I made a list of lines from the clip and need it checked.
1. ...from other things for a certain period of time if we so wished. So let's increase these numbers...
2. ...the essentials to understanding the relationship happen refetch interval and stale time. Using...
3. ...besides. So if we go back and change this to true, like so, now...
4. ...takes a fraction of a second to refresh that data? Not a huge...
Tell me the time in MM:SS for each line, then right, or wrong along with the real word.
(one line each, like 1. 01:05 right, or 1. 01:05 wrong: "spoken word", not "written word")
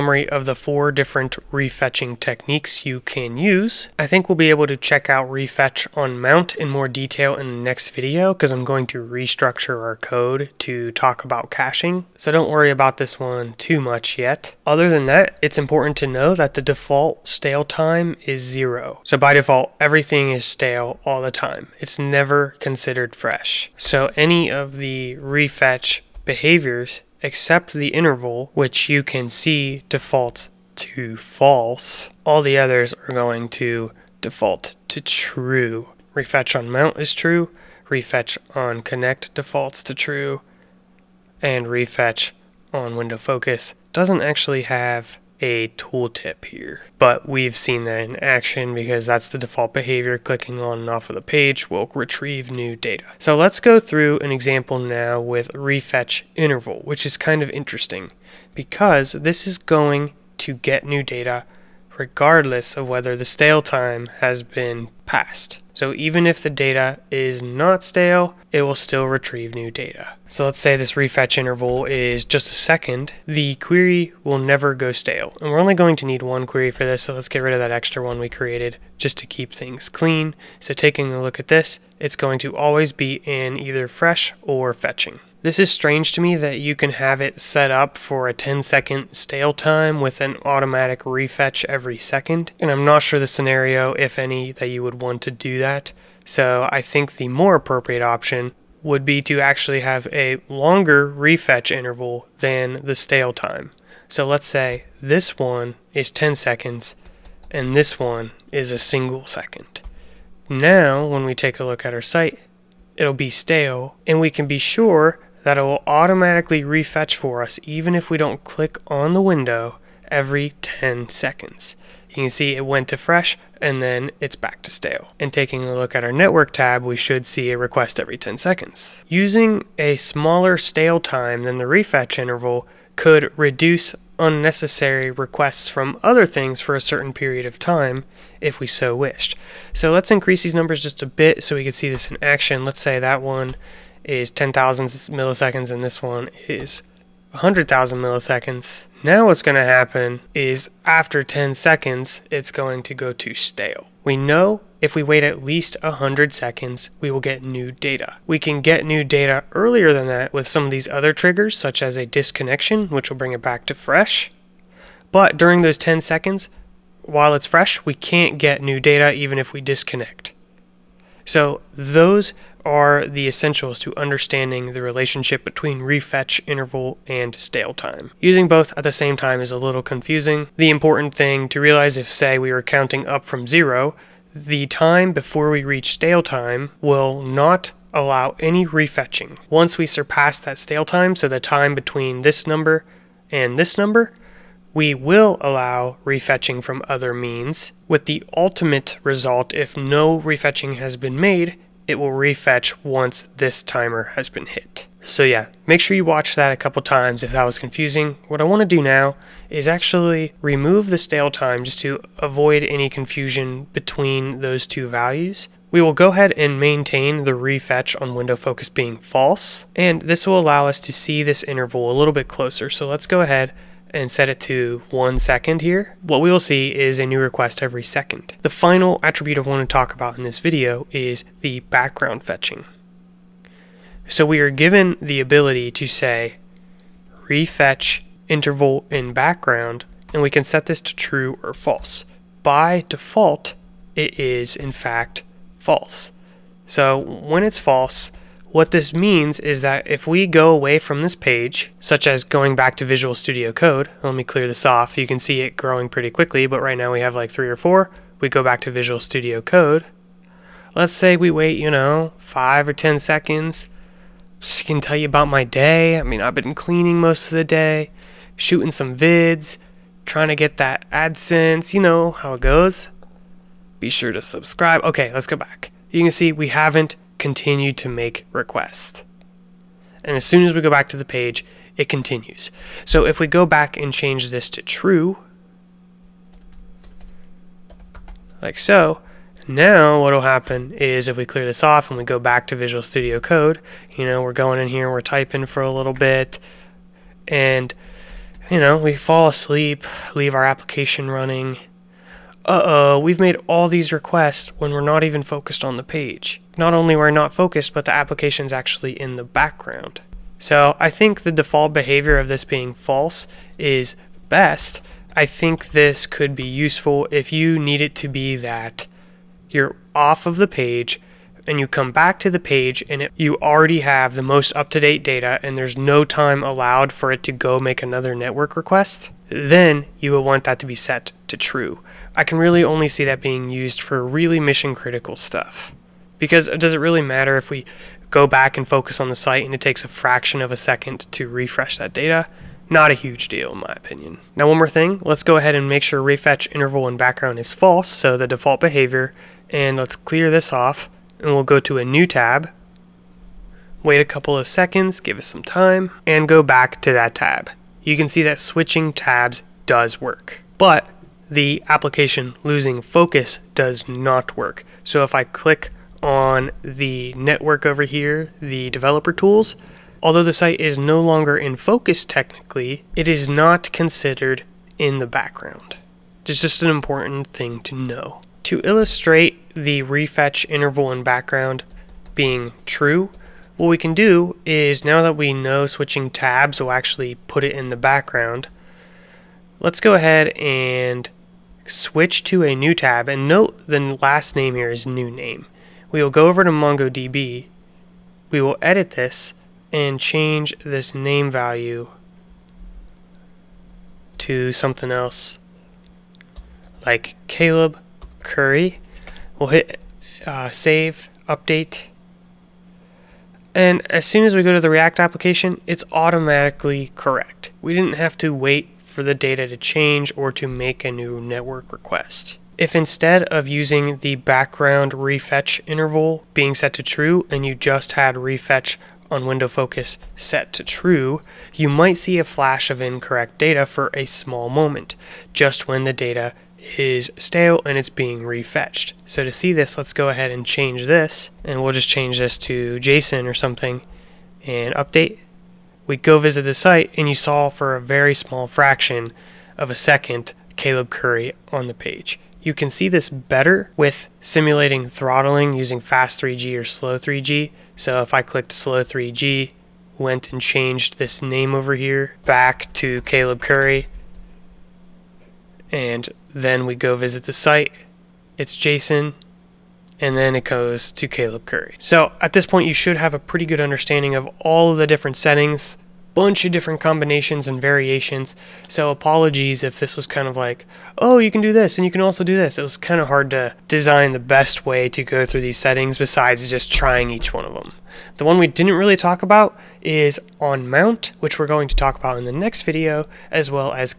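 1. 02:15 right
2. 02:53 wrong: "between", not "happen"
3. 04:41 wrong: "continues", not "besides"
4. 05:39 right.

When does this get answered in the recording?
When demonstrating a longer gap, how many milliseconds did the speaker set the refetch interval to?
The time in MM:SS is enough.
02:27.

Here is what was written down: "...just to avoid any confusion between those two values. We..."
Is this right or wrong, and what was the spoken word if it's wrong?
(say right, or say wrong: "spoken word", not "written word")
right.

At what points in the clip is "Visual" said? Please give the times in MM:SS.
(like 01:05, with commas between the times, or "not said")
04:12, 04:18, 04:52.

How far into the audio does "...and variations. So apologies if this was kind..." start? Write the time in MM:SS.
07:57.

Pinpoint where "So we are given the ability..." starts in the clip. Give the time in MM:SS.
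03:54.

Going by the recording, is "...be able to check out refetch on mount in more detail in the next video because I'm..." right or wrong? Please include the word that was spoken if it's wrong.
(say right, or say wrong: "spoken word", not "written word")
right.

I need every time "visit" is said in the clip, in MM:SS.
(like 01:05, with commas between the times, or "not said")
07:26, 07:46.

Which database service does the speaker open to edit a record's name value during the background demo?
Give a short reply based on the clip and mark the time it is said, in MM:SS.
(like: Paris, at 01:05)
MongoDB, at 06:36.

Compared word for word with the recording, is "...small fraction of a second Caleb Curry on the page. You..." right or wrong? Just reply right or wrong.
right.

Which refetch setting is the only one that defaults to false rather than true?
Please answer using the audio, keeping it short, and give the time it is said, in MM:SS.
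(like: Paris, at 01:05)
the interval, at 00:27.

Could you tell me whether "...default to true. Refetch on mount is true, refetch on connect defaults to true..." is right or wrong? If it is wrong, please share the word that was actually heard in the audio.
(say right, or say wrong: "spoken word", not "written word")
right.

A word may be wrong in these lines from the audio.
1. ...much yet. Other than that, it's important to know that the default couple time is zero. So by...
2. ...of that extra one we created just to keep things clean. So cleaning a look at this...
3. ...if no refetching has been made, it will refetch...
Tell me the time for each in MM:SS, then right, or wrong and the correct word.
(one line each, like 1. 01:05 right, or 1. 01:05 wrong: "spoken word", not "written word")
1. 00:13 wrong: "stale", not "couple"
2. 01:17 wrong: "taking", not "cleaning"
3. 03:19 right.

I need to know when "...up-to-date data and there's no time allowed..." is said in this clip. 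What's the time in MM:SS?
05:24.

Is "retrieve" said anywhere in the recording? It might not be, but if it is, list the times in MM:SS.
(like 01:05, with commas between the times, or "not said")
00:51, 01:09.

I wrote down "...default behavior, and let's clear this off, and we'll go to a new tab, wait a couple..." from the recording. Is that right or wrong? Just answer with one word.
right.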